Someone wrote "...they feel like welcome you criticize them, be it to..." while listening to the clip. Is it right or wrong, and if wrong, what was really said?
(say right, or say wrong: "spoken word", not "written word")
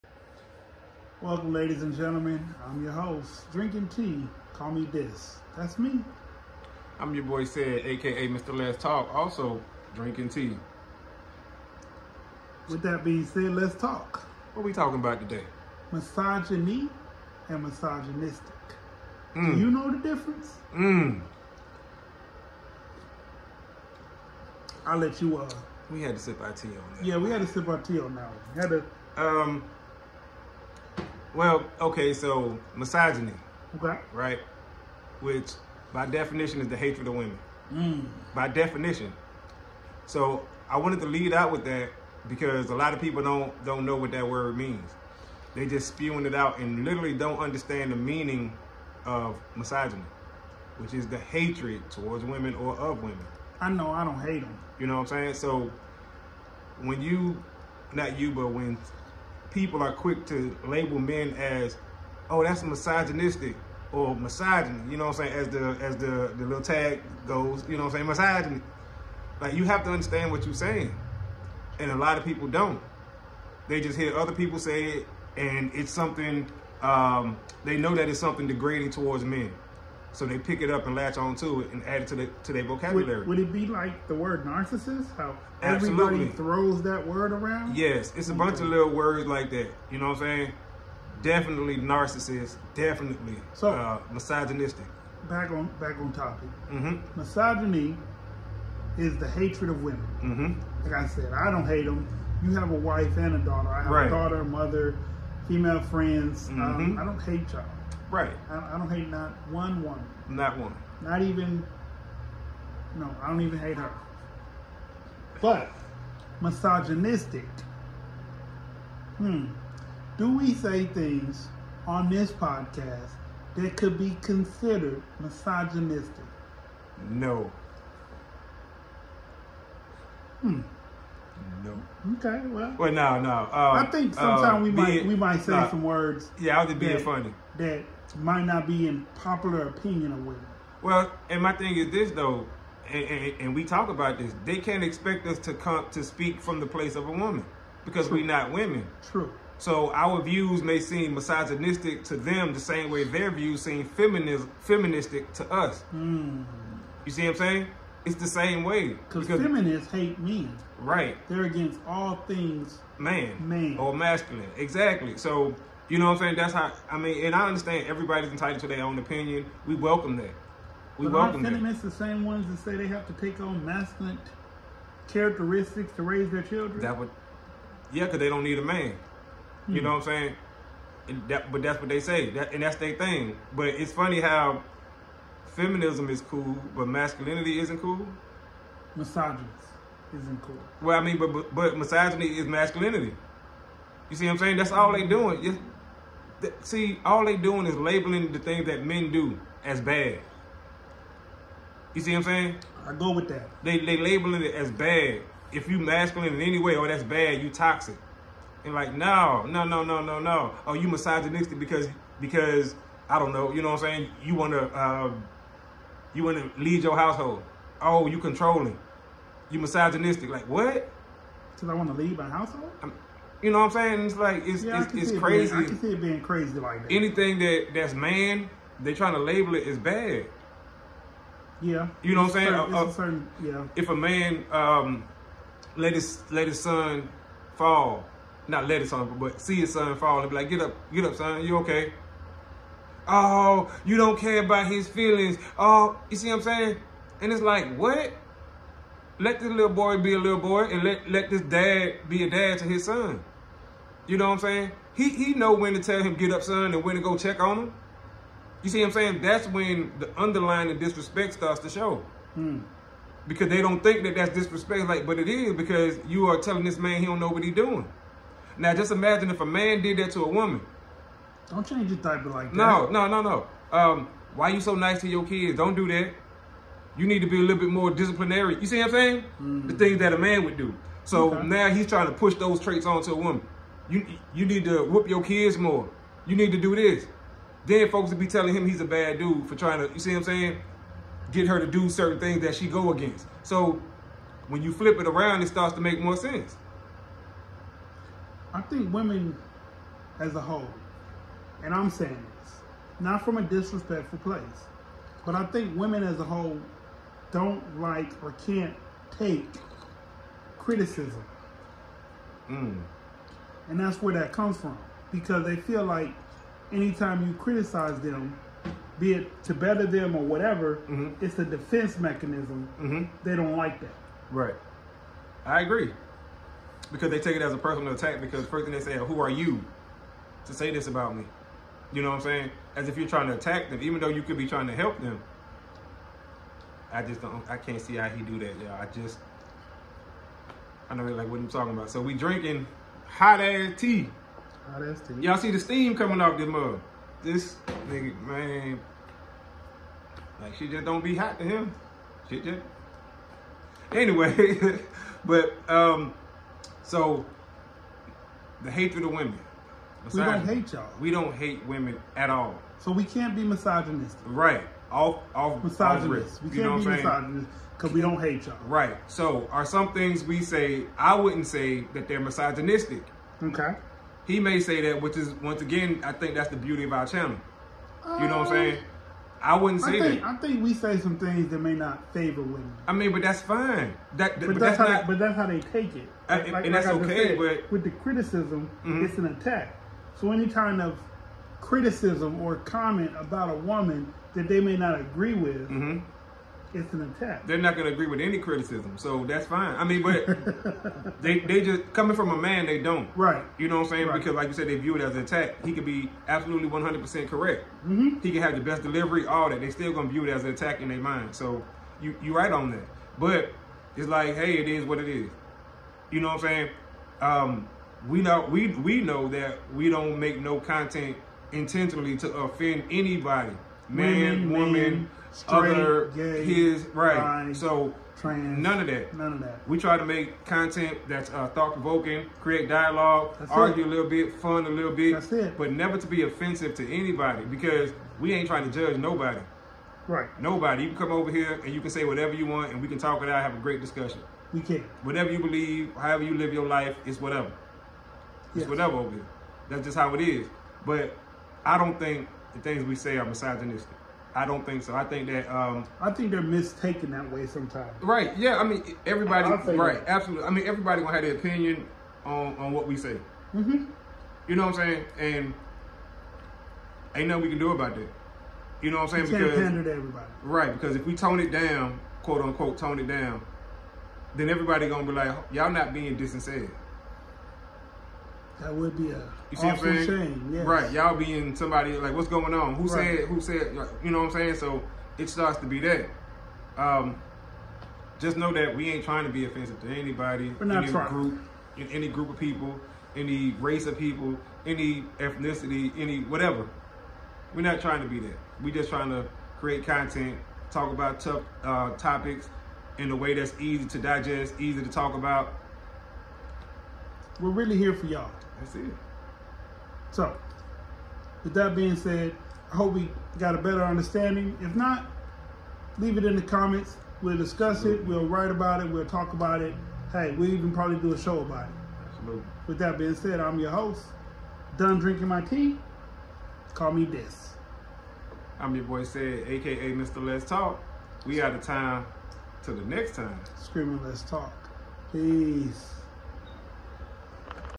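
wrong: "anytime", not "welcome".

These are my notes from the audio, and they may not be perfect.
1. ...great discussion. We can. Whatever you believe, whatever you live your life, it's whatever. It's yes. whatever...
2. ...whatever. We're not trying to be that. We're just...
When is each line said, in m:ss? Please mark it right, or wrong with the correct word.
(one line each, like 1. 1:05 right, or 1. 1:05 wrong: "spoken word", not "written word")
1. 7:23 wrong: "however", not "whatever"
2. 8:16 right.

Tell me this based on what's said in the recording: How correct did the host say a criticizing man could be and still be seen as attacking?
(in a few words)
100 percent.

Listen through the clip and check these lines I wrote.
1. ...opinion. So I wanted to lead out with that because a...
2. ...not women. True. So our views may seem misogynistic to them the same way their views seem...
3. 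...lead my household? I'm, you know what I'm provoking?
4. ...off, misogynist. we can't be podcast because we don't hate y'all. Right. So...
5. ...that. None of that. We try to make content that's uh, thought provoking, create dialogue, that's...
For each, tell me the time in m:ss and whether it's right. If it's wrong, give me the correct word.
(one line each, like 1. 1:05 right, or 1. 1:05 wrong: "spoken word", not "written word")
1. 0:38 wrong: "definition", not "opinion"
2. 2:28 right
3. 3:42 wrong: "saying", not "provoking"
4. 6:05 wrong: "misogynist", not "podcast"
5. 7:08 right.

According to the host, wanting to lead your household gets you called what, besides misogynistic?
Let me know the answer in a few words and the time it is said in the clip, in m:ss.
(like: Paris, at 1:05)
Controlling, at 3:38.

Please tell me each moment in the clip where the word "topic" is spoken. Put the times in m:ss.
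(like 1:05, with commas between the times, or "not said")
1:36, 8:21.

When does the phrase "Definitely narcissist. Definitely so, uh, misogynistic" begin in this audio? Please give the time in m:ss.
1:31.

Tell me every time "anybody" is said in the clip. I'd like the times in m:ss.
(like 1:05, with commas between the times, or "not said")
7:02, 7:16, 8:09.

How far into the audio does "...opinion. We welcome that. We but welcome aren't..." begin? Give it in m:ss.
2:48.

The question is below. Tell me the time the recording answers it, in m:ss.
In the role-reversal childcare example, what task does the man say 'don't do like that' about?
4:31.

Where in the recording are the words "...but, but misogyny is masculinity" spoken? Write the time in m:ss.
3:11.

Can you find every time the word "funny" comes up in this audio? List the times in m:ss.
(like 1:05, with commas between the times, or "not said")
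2:17, 3:03.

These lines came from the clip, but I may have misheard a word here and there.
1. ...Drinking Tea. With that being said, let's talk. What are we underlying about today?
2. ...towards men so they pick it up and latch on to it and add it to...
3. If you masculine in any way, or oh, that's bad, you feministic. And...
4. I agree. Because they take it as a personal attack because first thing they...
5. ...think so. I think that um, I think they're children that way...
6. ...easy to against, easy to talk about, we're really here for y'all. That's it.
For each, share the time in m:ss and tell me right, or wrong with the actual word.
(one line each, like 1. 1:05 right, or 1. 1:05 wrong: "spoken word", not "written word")
1. 0:09 wrong: "talking", not "underlying"
2. 1:18 right
3. 3:25 wrong: "toxic", not "feministic"
4. 5:25 right
5. 7:34 wrong: "mistaken", not "children"
6. 8:23 wrong: "digest", not "against".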